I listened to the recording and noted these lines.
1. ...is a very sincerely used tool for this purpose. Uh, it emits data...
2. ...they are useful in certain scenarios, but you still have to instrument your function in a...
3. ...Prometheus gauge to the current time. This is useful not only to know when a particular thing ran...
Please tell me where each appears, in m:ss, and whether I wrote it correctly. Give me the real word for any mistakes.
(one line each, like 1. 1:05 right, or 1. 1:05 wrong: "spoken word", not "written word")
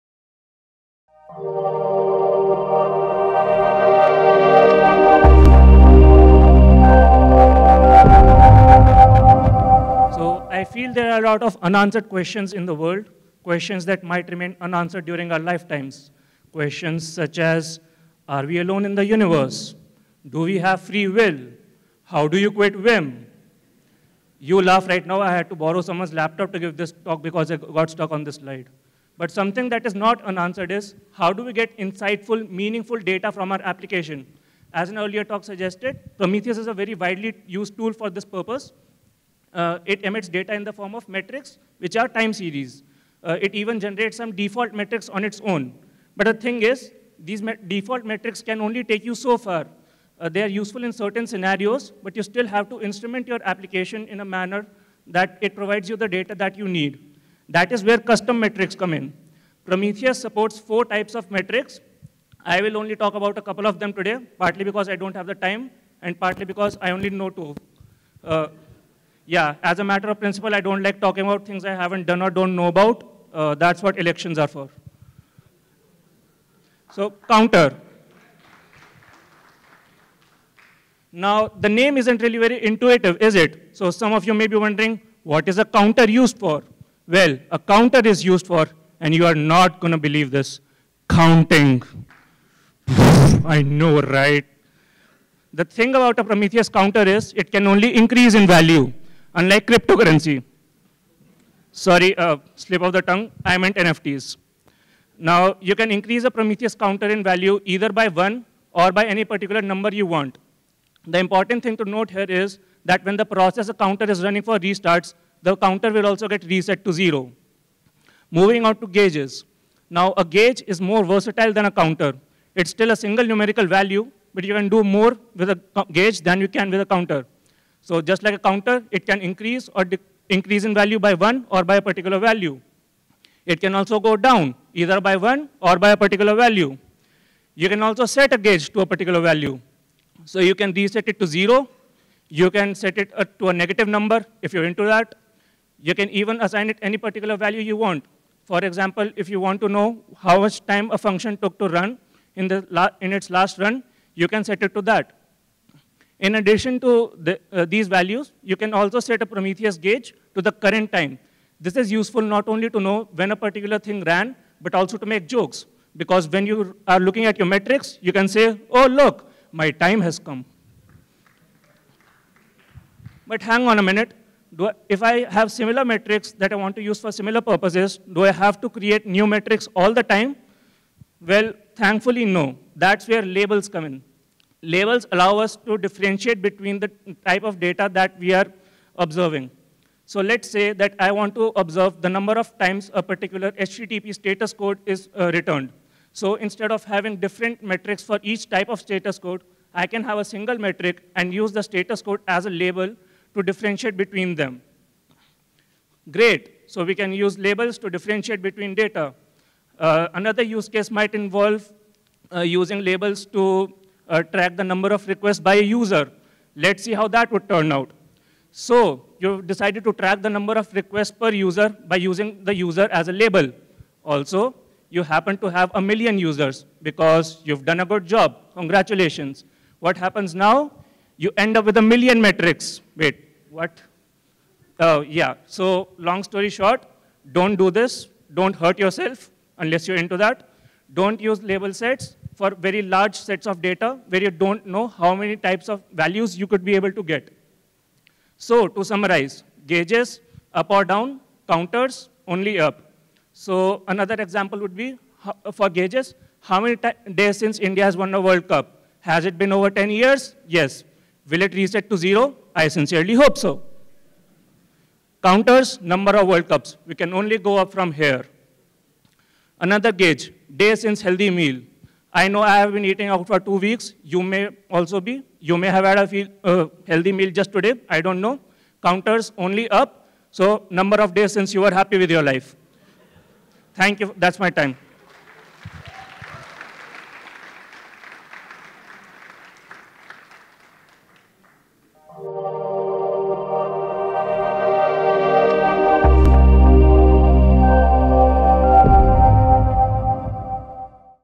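1. 0:36 wrong: "widely", not "sincerely"
2. 0:50 wrong: "application", not "function"
3. 2:39 right.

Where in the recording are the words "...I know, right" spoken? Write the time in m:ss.
1:32.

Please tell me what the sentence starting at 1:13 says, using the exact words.
Uh, that's what elections are for.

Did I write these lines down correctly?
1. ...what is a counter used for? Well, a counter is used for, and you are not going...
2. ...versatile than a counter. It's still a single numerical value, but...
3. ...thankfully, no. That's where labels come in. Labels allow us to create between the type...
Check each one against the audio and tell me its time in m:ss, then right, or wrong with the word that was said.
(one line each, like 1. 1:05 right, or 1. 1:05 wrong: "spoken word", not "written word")
1. 1:25 right
2. 2:01 right
3. 3:01 wrong: "differentiate", not "create".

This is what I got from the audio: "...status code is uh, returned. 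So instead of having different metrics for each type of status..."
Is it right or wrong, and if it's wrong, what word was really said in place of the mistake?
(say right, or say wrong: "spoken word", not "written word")
right.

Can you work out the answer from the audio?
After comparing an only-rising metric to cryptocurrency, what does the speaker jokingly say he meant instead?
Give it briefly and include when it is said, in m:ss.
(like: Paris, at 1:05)
NFTs, at 1:43.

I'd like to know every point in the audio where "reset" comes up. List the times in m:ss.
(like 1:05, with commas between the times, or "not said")
1:56, 2:20, 4:21.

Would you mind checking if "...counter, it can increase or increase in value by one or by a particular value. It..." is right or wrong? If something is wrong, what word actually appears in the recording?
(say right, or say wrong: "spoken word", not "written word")
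right.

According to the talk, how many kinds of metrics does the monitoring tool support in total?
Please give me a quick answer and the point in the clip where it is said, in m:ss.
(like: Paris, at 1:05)
4, at 1:00.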